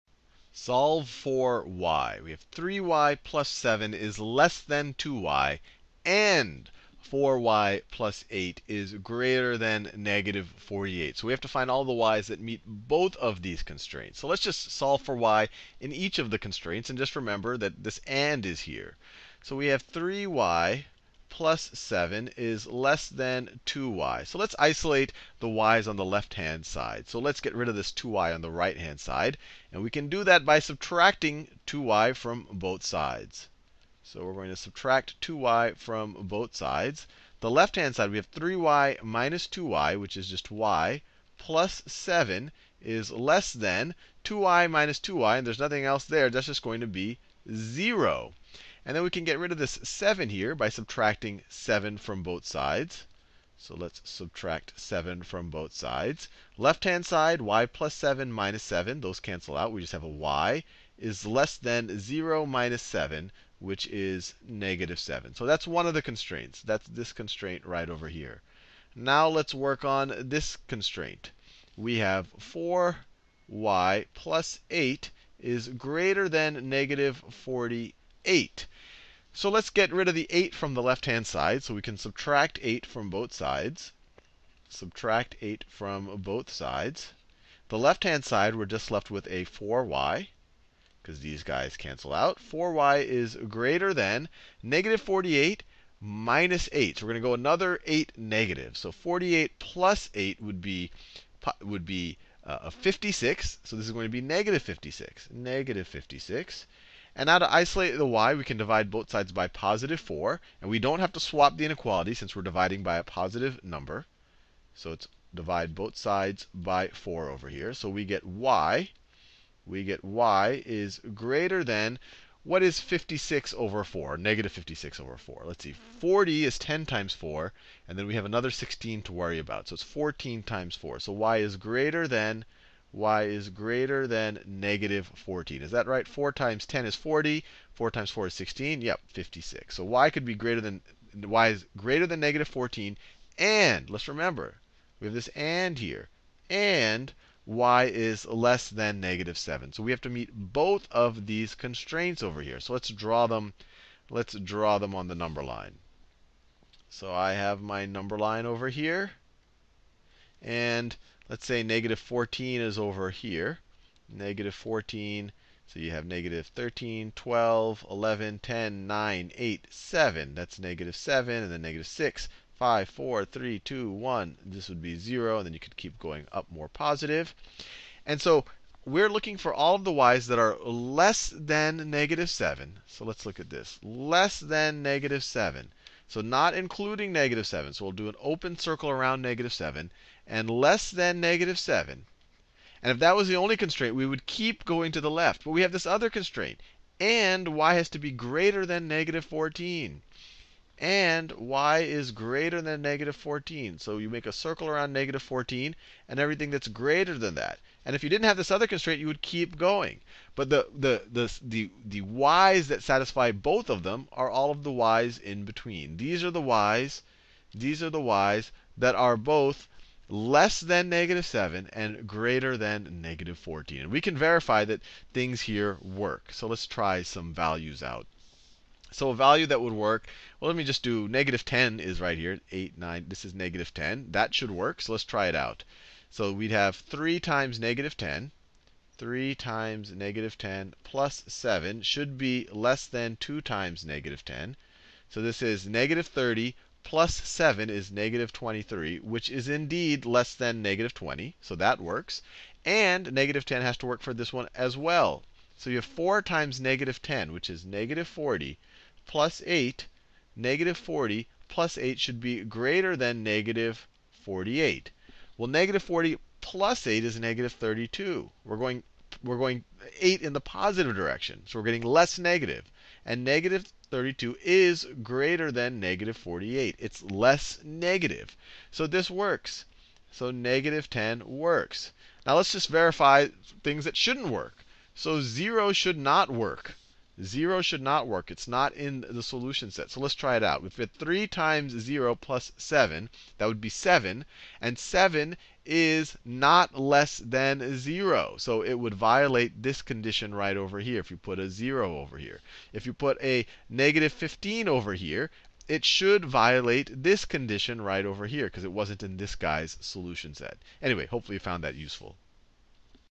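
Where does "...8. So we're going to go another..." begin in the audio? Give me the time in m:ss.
1:36.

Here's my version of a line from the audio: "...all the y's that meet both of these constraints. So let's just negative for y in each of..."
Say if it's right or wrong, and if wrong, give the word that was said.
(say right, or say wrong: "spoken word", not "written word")
wrong: "solve", not "negative".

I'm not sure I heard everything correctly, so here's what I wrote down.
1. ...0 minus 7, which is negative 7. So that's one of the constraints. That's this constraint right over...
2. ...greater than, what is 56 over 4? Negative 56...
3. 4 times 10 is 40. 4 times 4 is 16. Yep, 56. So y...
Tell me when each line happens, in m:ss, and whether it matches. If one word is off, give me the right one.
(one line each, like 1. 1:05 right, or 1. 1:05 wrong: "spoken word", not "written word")
1. 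1:01 right
2. 2:01 right
3. 2:16 right.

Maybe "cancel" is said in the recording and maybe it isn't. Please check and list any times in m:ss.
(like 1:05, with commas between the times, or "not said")
0:59, 1:31.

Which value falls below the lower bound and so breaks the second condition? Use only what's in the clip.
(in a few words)
-15.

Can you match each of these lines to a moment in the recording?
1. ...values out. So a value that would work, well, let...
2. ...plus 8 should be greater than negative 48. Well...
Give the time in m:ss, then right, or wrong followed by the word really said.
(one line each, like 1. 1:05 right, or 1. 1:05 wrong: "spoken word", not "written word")
1. 3:47 right
2. 4:21 right.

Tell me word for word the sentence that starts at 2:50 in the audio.
That's negative 7, and then negative 6, 5, 4, 3, 2, 1.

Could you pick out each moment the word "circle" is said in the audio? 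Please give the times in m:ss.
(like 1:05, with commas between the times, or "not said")
3:08, 3:24.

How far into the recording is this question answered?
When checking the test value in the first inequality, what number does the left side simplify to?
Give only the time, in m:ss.
4:07.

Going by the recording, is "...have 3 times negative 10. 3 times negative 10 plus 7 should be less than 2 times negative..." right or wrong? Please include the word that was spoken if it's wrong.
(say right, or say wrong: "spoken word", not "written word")
right.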